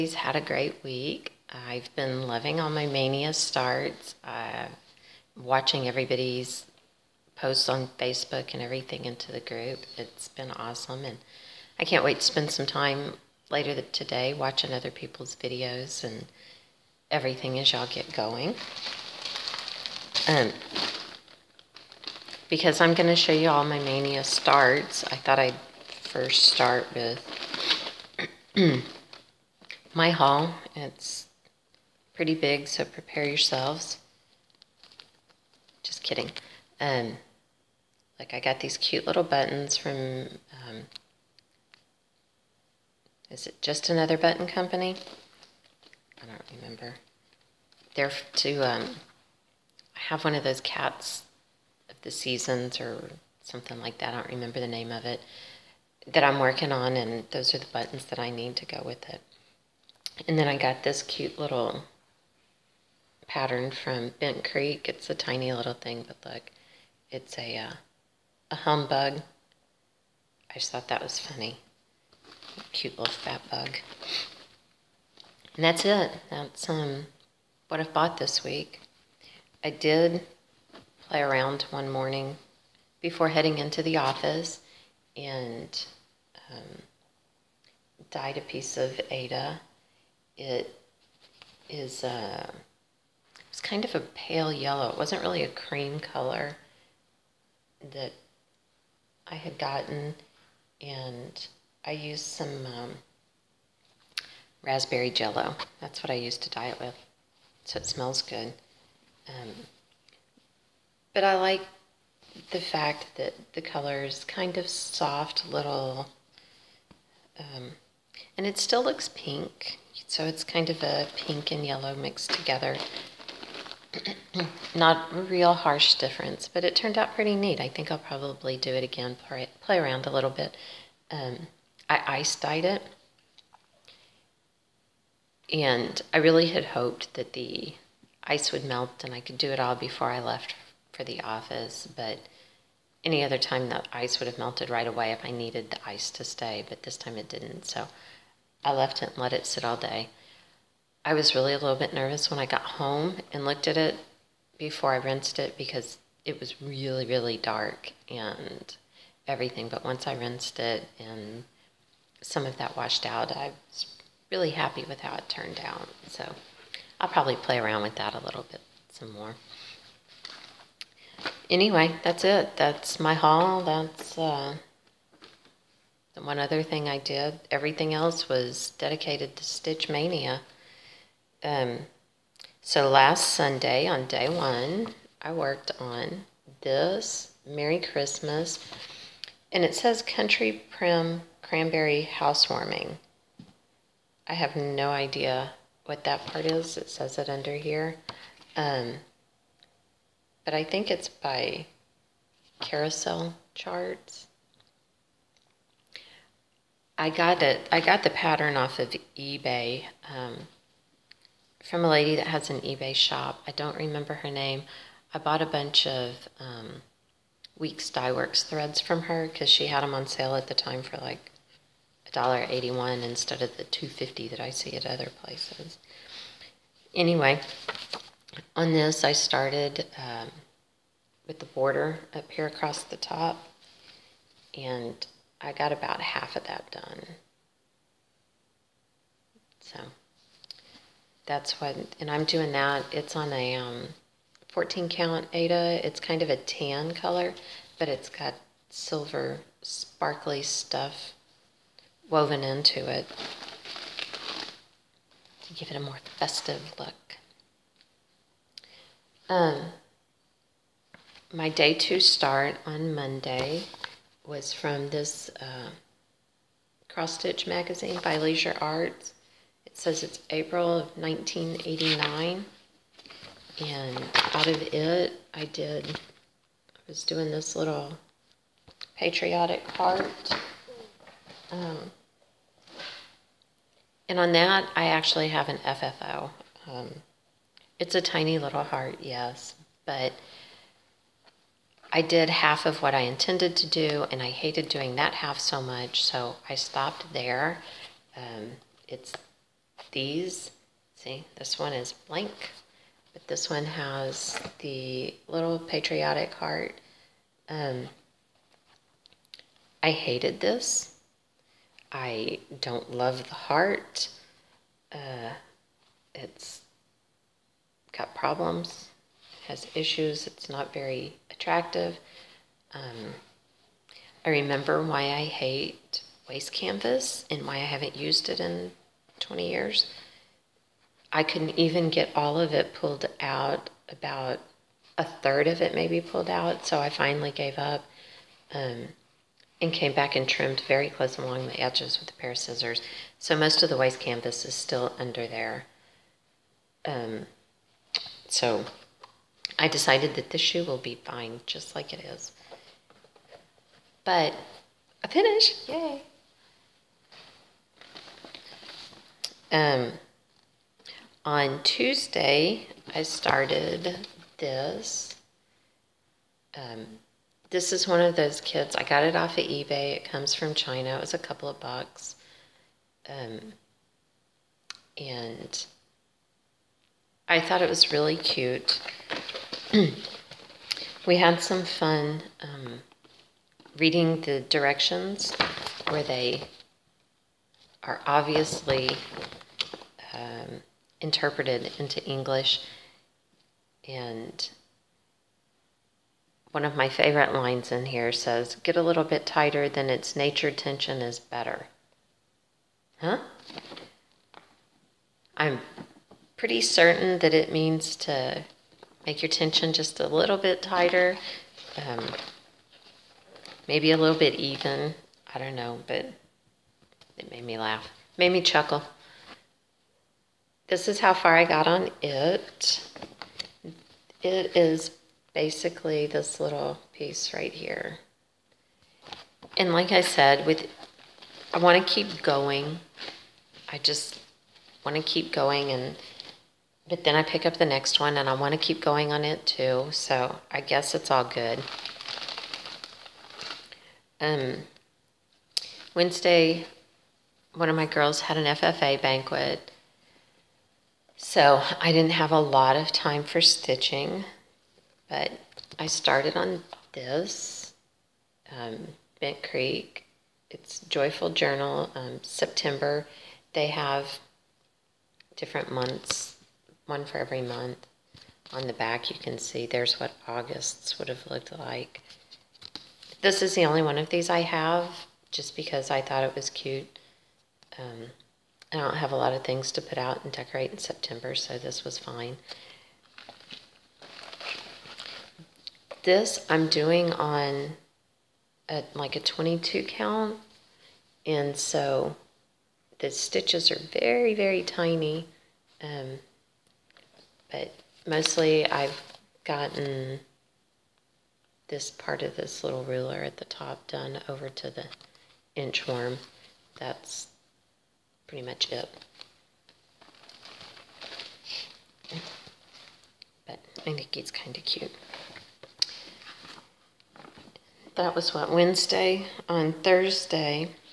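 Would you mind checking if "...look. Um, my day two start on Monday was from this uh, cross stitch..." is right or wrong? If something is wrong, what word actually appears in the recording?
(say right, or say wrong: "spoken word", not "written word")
right.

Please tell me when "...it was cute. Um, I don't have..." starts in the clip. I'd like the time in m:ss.
7:56.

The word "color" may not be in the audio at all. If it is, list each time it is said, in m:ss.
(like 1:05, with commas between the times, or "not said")
1:36, 1:53, 4:06.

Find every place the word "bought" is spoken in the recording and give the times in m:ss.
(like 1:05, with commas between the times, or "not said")
1:17, 3:35.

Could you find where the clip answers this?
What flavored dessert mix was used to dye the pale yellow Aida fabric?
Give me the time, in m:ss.
1:44.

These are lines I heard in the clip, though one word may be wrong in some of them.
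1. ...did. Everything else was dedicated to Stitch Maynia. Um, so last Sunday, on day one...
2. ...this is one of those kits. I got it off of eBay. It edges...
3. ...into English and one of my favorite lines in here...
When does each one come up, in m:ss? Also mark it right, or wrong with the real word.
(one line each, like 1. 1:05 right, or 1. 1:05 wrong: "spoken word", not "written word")
1. 2:56 right
2. 6:07 wrong: "comes", not "edges"
3. 6:31 right.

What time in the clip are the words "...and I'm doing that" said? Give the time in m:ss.
4:01.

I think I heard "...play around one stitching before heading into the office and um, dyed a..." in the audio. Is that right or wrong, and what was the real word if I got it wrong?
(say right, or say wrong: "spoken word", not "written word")
wrong: "morning", not "stitching".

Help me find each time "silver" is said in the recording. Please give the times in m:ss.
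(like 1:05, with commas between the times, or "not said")
4:08.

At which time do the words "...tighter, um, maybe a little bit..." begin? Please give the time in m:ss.
6:50.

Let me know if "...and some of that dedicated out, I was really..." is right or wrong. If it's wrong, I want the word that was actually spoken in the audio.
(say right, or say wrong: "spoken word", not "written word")
wrong: "washed", not "dedicated".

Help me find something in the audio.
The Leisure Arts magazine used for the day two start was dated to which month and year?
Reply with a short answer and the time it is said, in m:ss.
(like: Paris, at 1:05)
April 1989, at 4:30.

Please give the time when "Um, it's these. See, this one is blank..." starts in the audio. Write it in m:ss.
4:58.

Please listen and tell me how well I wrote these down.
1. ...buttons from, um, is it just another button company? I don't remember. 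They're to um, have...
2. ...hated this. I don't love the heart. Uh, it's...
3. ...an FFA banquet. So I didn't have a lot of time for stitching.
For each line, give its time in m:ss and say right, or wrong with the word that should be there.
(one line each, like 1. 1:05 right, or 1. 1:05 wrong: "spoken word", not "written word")
1. 0:39 right
2. 5:09 right
3. 7:28 right.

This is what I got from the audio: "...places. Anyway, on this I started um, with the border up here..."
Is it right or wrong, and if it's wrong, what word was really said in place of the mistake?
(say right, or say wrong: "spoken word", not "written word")
right.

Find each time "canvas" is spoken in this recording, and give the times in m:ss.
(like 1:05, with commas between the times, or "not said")
5:26, 5:44.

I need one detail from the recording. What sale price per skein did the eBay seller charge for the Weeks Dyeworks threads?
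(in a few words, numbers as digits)
$1.81.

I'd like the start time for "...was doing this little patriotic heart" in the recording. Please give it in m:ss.
4:36.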